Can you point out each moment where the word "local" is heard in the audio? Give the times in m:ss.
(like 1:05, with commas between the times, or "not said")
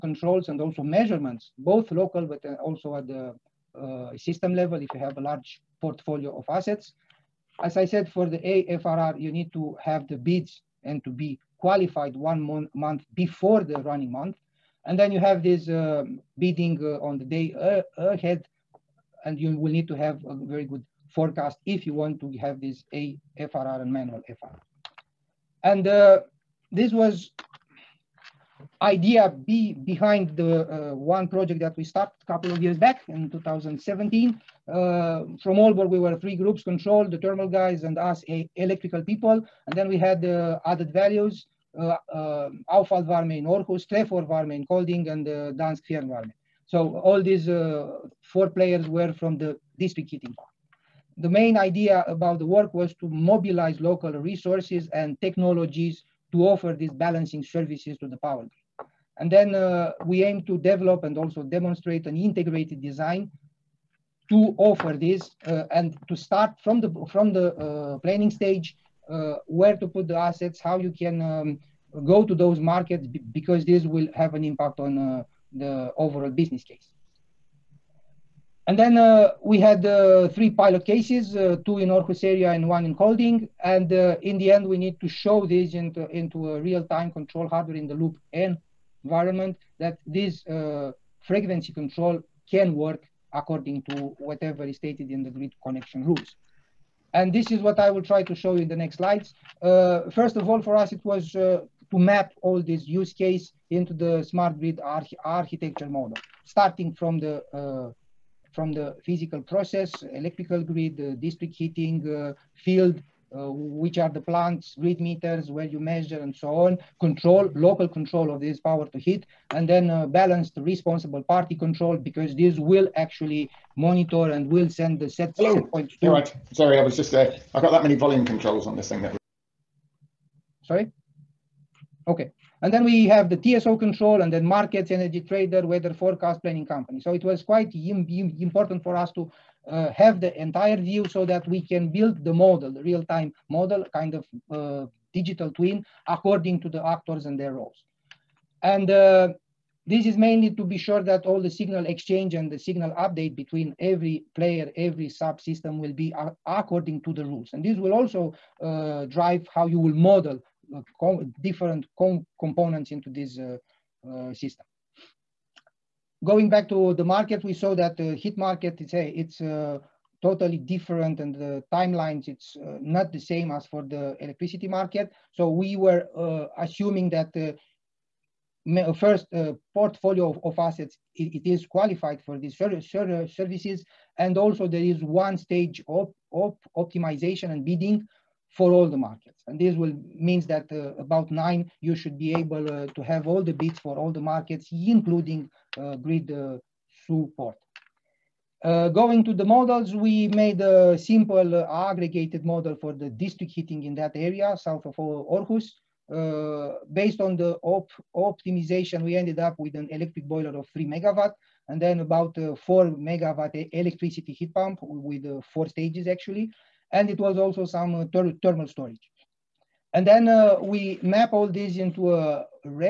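0:01, 0:53, 1:57.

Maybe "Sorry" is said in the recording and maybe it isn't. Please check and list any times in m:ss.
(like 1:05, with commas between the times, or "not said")
2:06, 2:10.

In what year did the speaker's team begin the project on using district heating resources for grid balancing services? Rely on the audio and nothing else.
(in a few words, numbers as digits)
2017.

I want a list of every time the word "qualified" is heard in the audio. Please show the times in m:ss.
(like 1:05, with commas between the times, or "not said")
0:11, 3:01.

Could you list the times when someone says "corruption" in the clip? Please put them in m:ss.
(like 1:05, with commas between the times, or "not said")
not said.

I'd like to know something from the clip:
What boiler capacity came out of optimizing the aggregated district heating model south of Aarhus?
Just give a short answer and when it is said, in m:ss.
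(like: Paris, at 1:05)
3 megawatt, at 3:30.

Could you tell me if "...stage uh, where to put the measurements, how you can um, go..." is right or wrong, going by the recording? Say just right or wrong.
wrong.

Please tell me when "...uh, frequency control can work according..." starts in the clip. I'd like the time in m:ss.
1:30.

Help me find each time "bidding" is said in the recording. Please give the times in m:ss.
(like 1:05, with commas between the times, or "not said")
0:16, 3:07.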